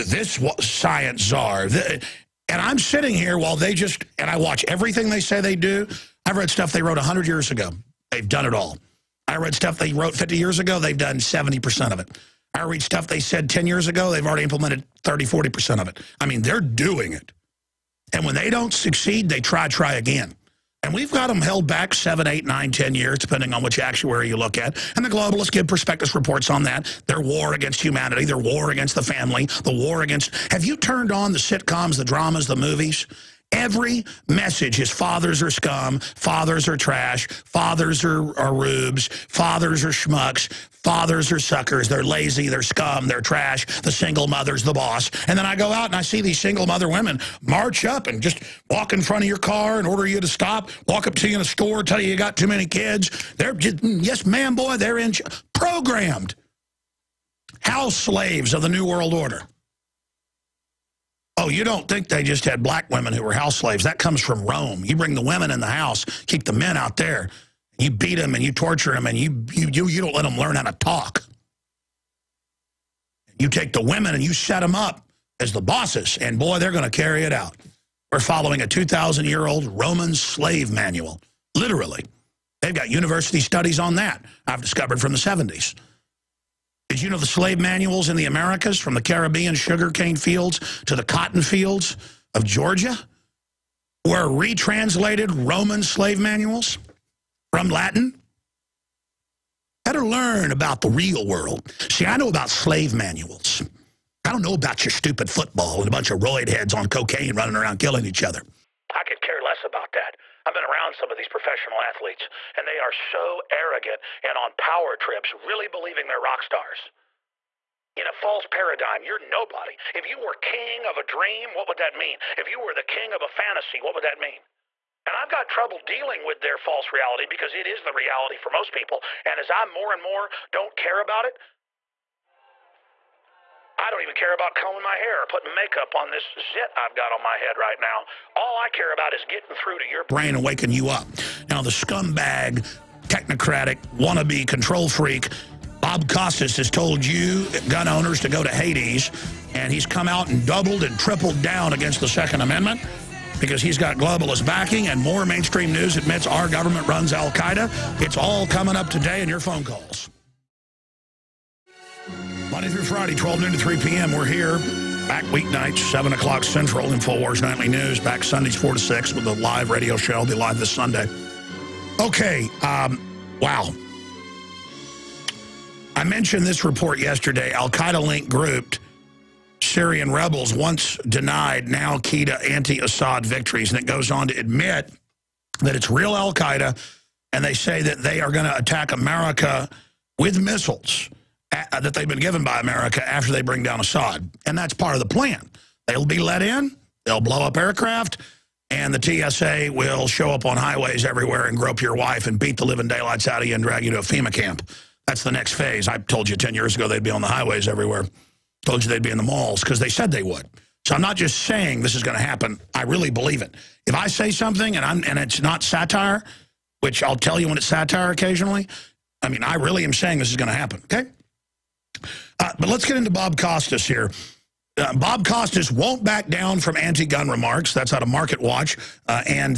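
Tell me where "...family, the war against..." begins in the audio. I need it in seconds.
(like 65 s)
29 s.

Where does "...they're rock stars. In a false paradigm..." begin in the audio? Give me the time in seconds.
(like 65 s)
116 s.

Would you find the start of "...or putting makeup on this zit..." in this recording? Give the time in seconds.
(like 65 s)
135 s.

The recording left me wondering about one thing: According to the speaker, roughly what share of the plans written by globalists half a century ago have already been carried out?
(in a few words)
70%.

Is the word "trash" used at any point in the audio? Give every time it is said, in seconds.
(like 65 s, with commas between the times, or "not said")
36 s, 43 s.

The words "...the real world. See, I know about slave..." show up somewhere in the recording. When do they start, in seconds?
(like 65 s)
100 s.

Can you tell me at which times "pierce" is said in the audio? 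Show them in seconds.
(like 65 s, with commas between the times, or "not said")
not said.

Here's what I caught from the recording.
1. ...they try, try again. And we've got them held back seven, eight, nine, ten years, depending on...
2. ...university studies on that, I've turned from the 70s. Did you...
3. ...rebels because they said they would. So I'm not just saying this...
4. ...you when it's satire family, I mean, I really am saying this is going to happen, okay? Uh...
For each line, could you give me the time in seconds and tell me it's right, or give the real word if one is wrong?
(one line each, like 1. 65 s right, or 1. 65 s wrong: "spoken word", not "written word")
1. 19 s right
2. 82 s wrong: "discovered", not "turned"
3. 209 s wrong: "malls", not "rebels"
4. 217 s wrong: "occasionally", not "family".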